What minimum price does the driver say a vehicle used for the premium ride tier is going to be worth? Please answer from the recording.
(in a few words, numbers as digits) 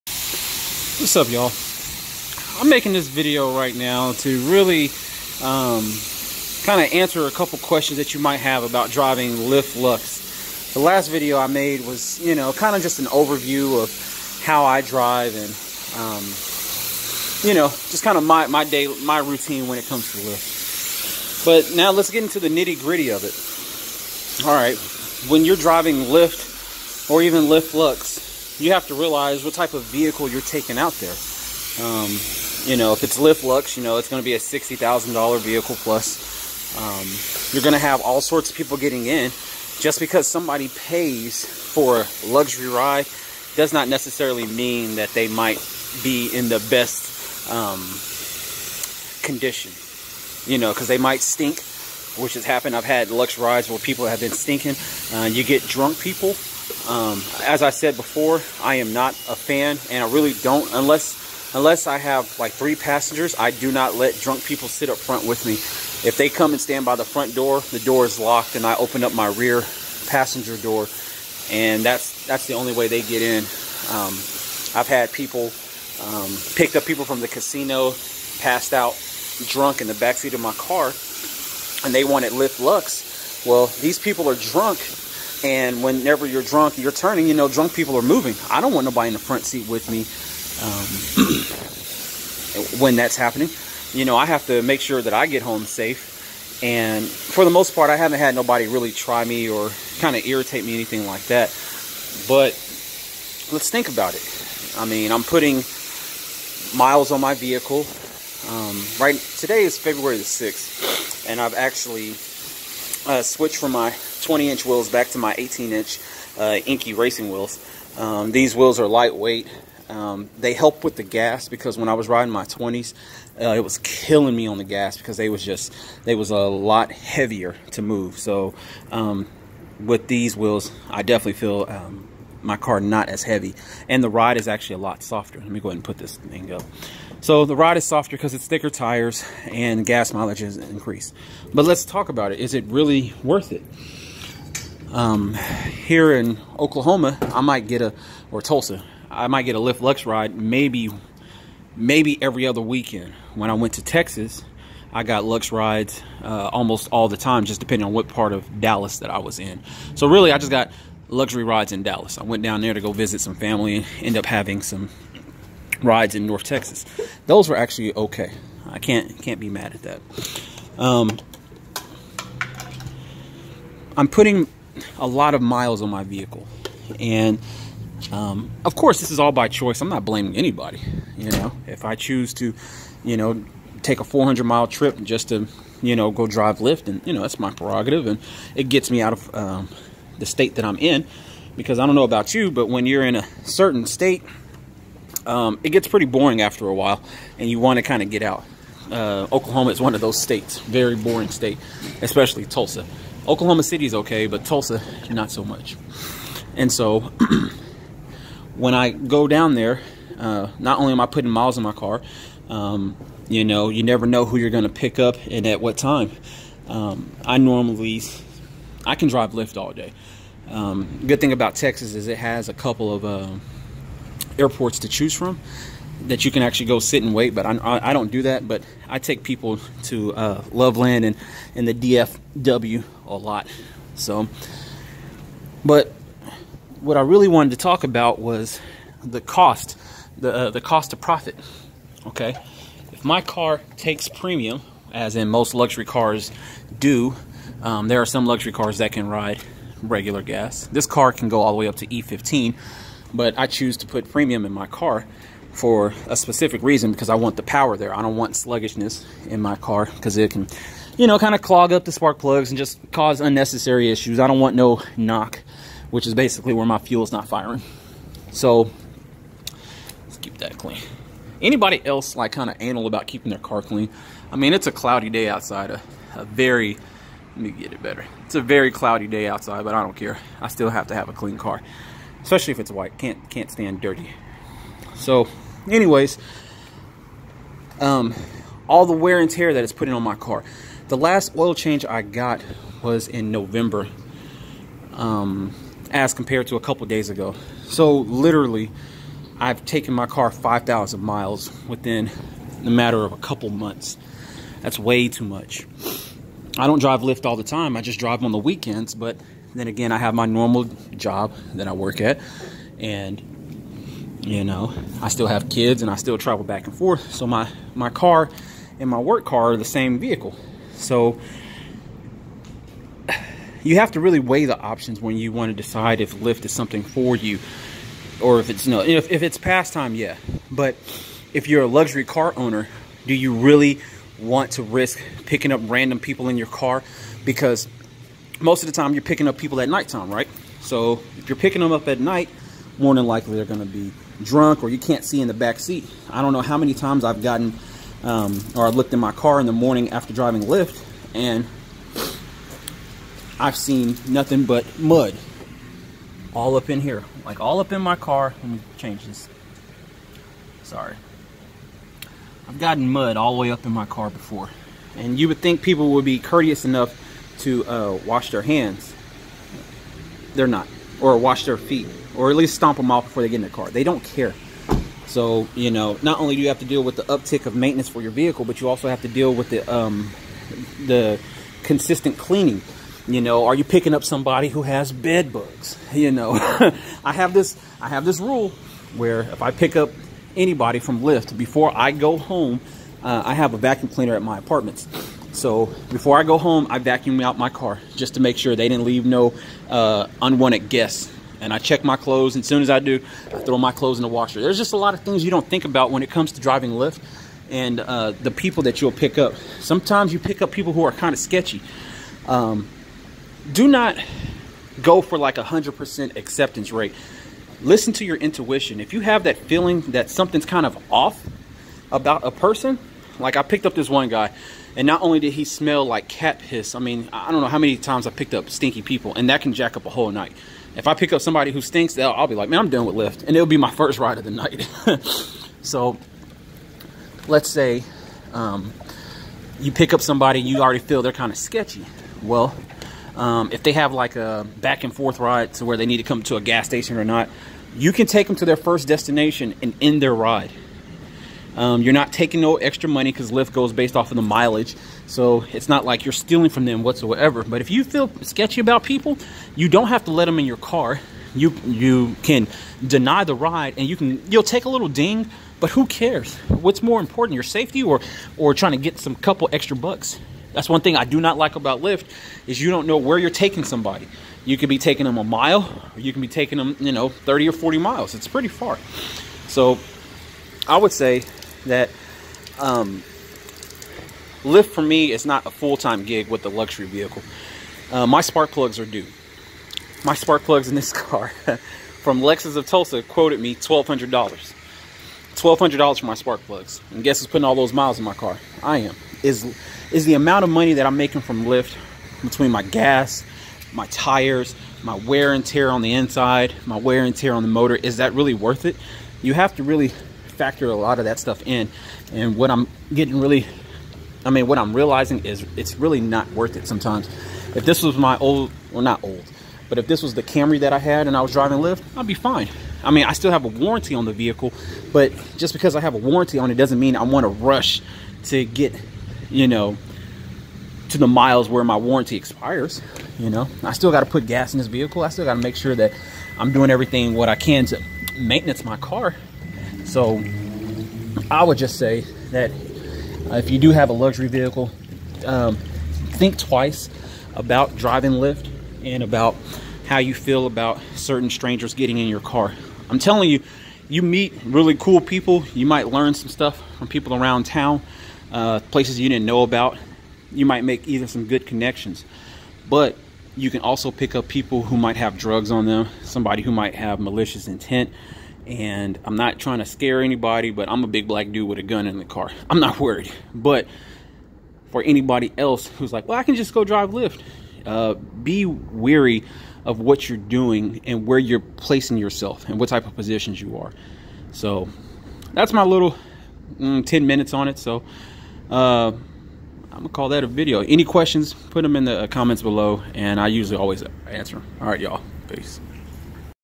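$60,000.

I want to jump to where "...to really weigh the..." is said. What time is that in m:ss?
5:23.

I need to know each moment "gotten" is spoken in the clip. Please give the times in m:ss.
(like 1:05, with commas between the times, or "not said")
5:47, 6:02.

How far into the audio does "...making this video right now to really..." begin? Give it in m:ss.
0:02.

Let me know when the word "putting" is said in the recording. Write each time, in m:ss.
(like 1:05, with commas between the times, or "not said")
1:45, 2:54, 3:31, 4:49, 8:17.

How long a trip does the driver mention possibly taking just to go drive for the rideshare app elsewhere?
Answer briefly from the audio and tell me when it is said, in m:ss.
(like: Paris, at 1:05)
400 miles, at 3:04.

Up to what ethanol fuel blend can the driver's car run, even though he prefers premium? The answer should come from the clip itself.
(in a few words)
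E15.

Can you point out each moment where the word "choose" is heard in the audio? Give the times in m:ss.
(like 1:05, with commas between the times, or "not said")
3:01, 3:44, 4:13.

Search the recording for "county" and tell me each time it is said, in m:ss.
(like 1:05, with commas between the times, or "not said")
not said.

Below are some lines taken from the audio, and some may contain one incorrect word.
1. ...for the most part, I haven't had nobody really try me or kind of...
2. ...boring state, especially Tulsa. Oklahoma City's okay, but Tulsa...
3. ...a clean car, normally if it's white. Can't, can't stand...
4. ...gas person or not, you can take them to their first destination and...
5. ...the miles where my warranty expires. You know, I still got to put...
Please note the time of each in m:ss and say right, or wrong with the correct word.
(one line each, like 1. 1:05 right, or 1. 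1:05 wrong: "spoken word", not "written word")
1. 1:37 right
2. 3:20 right
3. 4:41 wrong: "especially", not "normally"
4. 7:26 wrong: "station", not "person"
5. 8:50 right.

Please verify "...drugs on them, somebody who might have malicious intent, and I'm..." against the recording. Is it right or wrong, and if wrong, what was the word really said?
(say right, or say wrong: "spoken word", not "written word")
right.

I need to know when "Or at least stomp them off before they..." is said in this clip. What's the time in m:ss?
6:12.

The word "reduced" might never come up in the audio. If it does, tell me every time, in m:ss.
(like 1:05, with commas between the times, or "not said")
not said.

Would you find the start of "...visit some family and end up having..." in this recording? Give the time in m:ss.
2:42.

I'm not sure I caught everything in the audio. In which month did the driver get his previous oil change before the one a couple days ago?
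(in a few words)
November.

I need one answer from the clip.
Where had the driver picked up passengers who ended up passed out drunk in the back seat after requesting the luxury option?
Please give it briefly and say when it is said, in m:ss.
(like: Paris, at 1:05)
the casino, at 1:17.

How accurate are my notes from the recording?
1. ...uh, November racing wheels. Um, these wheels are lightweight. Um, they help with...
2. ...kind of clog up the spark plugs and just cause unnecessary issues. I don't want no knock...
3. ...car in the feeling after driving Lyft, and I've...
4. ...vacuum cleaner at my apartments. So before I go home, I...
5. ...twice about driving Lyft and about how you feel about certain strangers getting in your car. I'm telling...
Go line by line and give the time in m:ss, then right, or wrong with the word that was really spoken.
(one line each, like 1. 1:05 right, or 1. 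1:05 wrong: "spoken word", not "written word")
1. 1:56 wrong: "Enkei", not "November"
2. 4:21 right
3. 5:49 wrong: "morning", not "feeling"
4. 6:33 right
5. 9:06 right.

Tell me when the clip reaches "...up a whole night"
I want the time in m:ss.
7:09.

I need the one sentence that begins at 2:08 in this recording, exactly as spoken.
So um, with these wheels, I definitely feel um, my car not as heavy.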